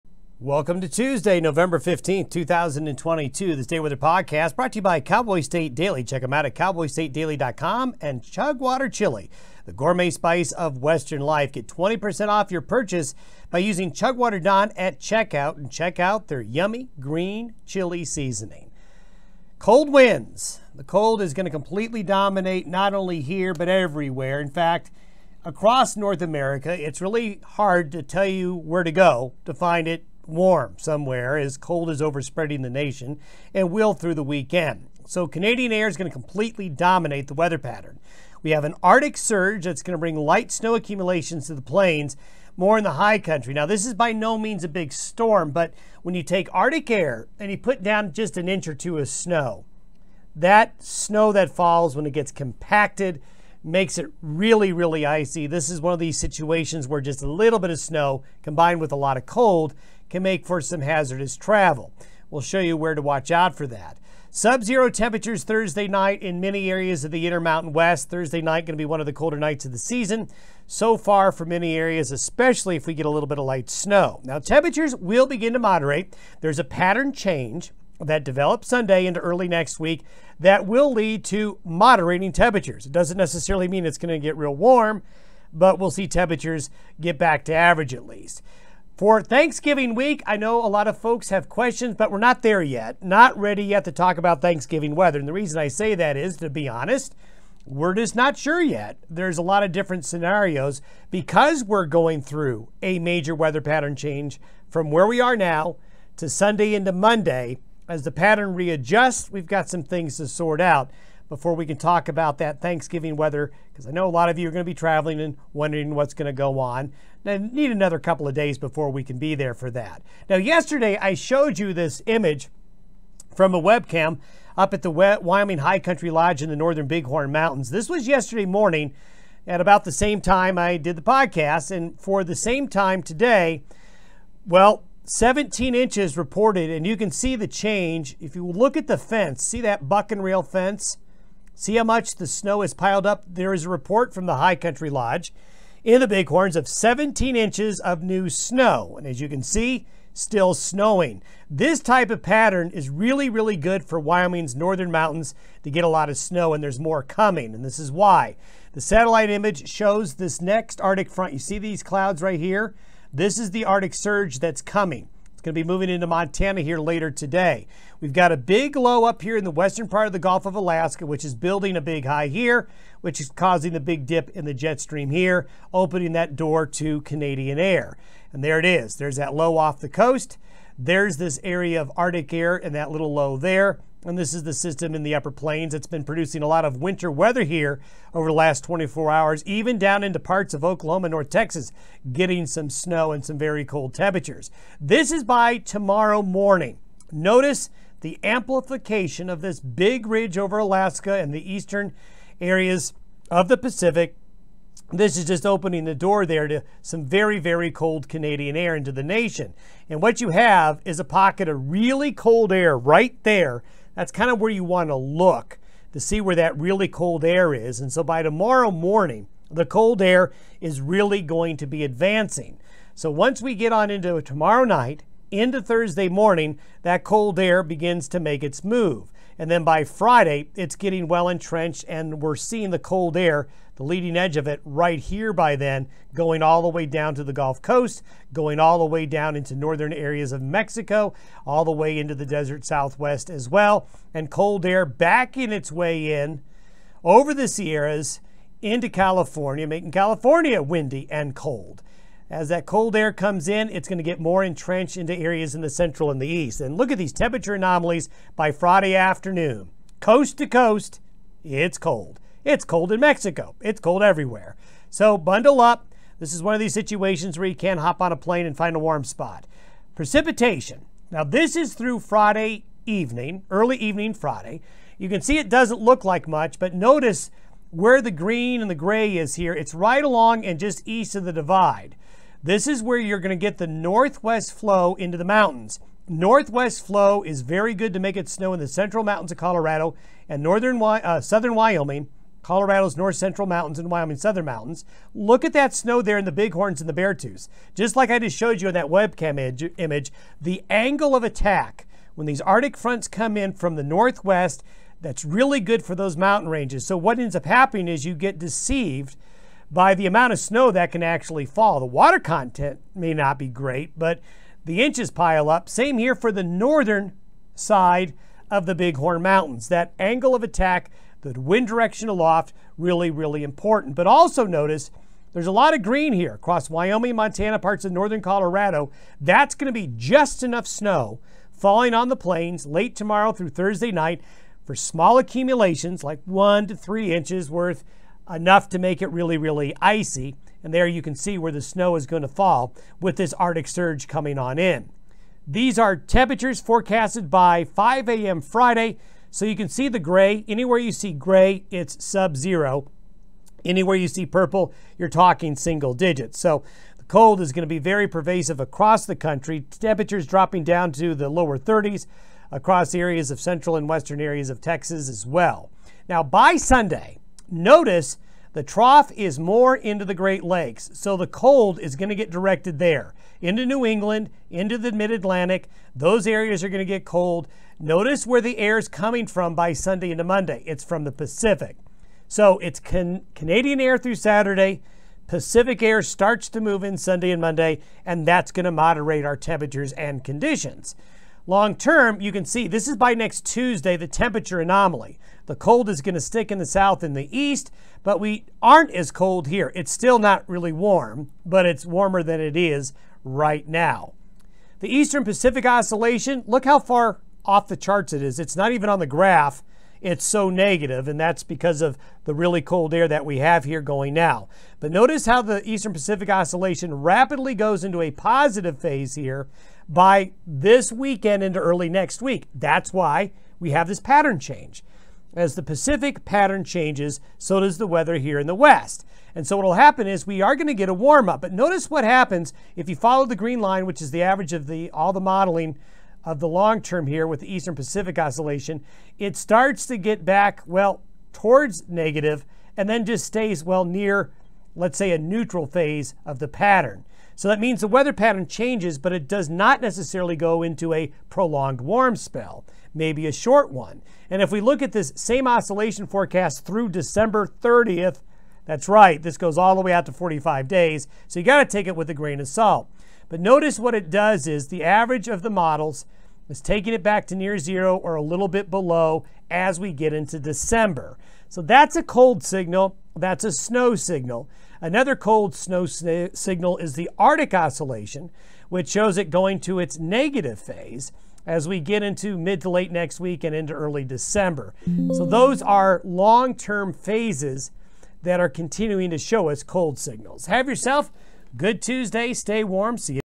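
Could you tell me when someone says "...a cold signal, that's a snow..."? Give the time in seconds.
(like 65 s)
471 s.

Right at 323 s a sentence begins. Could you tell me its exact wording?
But also notice there's a lot of green here across Wyoming, Montana, parts of northern Colorado.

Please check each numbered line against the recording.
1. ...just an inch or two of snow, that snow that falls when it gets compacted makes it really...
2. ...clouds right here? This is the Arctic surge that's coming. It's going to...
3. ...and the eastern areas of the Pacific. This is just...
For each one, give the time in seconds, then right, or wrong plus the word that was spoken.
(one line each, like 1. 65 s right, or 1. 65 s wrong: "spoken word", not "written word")
1. 48 s right
2. 161 s right
3. 201 s right.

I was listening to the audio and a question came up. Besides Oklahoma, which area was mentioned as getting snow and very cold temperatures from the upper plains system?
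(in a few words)
North Texas.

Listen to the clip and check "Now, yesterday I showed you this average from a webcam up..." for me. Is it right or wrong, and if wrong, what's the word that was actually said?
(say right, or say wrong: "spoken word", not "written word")
wrong: "image", not "average".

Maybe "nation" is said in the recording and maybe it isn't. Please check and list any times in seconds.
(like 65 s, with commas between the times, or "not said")
32 s, 209 s.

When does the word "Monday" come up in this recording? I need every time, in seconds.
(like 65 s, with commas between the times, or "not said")
106 s, 380 s, 387 s.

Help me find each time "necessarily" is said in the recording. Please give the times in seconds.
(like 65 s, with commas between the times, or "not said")
83 s, 449 s.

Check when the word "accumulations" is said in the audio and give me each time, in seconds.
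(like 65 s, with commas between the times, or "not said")
40 s, 335 s.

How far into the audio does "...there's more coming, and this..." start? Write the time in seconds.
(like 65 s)
156 s.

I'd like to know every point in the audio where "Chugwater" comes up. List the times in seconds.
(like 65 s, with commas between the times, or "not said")
8 s, 13 s.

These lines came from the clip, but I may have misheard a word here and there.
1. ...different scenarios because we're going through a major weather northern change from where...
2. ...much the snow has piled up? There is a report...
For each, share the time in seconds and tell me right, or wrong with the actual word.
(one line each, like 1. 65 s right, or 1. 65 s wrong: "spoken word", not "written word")
1. 99 s wrong: "pattern", not "northern"
2. 141 s right.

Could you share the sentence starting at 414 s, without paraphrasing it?
But notice how the Eastern Pacific Oscillation rapidly goes into a positive phase here by this weekend into early next week.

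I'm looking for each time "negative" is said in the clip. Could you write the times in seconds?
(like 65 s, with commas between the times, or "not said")
410 s, 441 s, 479 s.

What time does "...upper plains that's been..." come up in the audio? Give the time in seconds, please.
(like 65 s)
185 s.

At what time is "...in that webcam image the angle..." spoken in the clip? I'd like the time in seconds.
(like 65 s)
298 s.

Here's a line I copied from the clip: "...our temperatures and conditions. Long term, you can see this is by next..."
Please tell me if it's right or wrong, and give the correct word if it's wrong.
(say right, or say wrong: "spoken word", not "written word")
right.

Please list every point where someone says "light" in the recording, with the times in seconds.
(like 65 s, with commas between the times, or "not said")
40 s, 73 s.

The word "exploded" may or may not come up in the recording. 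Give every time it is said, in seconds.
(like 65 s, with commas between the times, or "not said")
not said.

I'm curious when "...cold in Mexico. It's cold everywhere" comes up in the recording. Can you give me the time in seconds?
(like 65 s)
262 s.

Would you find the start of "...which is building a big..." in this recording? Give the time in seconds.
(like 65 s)
171 s.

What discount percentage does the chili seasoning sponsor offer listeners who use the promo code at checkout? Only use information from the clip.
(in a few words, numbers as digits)
20%.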